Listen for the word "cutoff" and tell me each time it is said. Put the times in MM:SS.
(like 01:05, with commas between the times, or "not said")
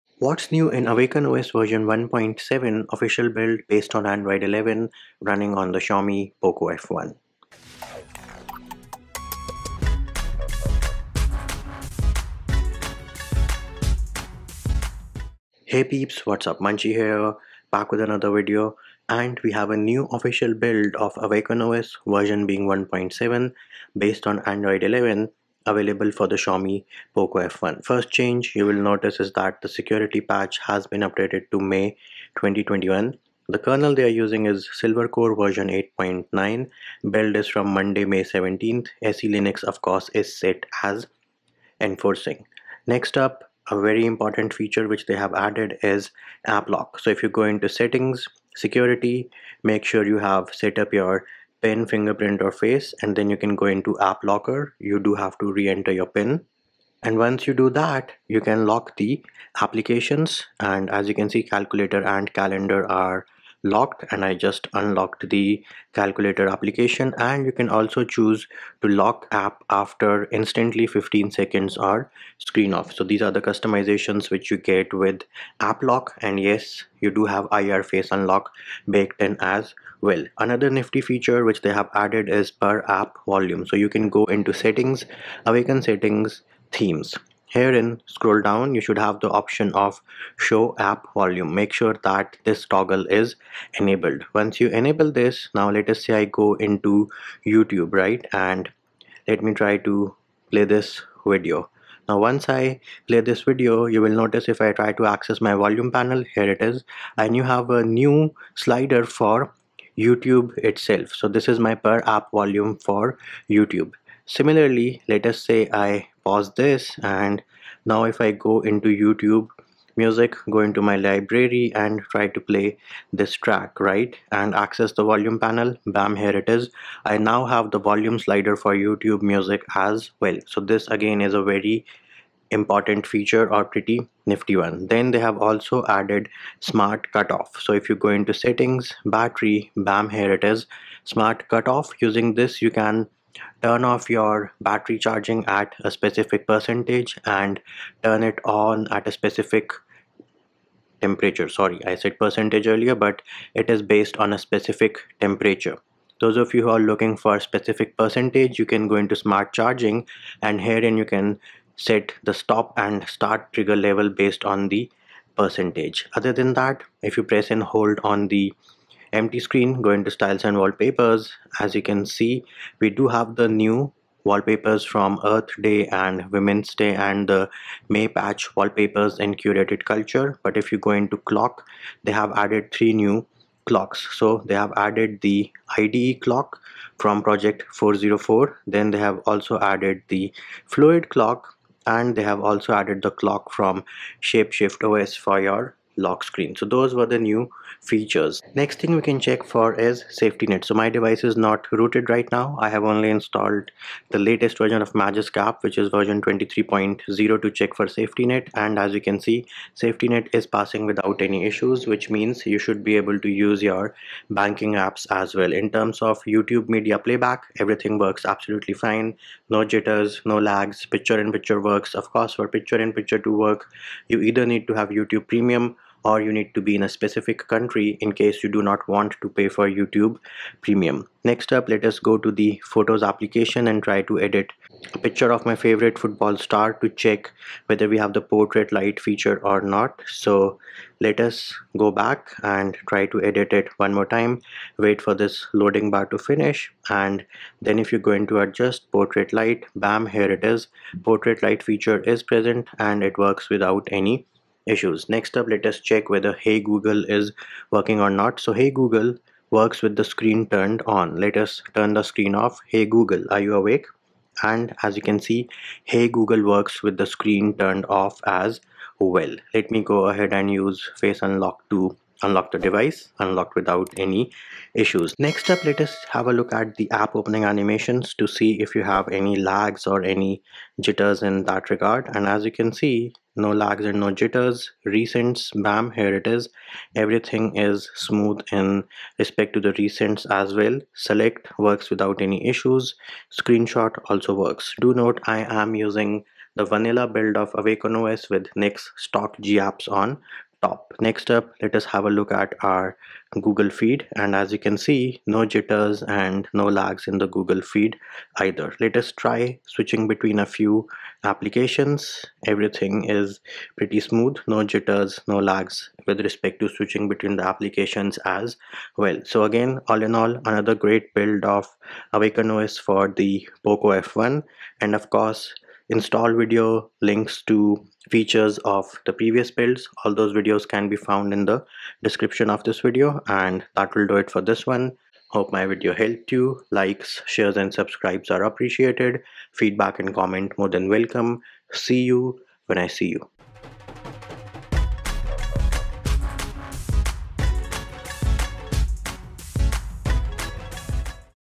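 02:17, 02:21.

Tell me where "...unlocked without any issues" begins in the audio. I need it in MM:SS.
04:33.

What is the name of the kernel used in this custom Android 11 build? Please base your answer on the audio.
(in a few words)
Silvercore.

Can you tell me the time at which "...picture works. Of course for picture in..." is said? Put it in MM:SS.
03:41.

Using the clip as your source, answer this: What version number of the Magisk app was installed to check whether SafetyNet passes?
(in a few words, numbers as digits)
23.0.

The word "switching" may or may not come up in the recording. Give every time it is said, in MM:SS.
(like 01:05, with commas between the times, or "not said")
05:09, 05:16.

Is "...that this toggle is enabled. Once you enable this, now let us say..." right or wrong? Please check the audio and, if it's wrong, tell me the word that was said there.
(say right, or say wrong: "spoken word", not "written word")
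right.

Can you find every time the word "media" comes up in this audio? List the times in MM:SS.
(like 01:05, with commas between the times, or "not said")
03:36.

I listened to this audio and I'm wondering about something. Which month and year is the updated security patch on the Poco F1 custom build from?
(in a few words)
May 2021.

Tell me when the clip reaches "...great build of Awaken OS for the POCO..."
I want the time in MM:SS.
05:20.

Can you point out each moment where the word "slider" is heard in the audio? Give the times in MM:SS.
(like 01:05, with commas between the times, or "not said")
01:48, 02:08.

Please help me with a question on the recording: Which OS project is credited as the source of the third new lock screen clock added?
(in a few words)
shapeshift os.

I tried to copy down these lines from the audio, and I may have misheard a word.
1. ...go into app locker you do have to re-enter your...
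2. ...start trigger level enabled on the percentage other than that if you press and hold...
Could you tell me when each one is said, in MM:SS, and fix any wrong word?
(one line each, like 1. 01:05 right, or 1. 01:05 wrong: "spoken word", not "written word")
1. 00:53 right
2. 02:43 wrong: "based", not "enabled".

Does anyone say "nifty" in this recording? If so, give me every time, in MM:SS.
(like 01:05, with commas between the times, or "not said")
01:20, 02:14.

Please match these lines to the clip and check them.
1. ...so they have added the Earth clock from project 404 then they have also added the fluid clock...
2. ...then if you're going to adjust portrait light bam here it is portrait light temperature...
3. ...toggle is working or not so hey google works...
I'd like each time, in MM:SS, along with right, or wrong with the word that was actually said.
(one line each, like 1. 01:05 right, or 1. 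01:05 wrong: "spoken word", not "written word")
1. 03:04 wrong: "IDE", not "Earth"
2. 04:07 wrong: "feature", not "temperature"
3. 04:16 wrong: "google", not "toggle".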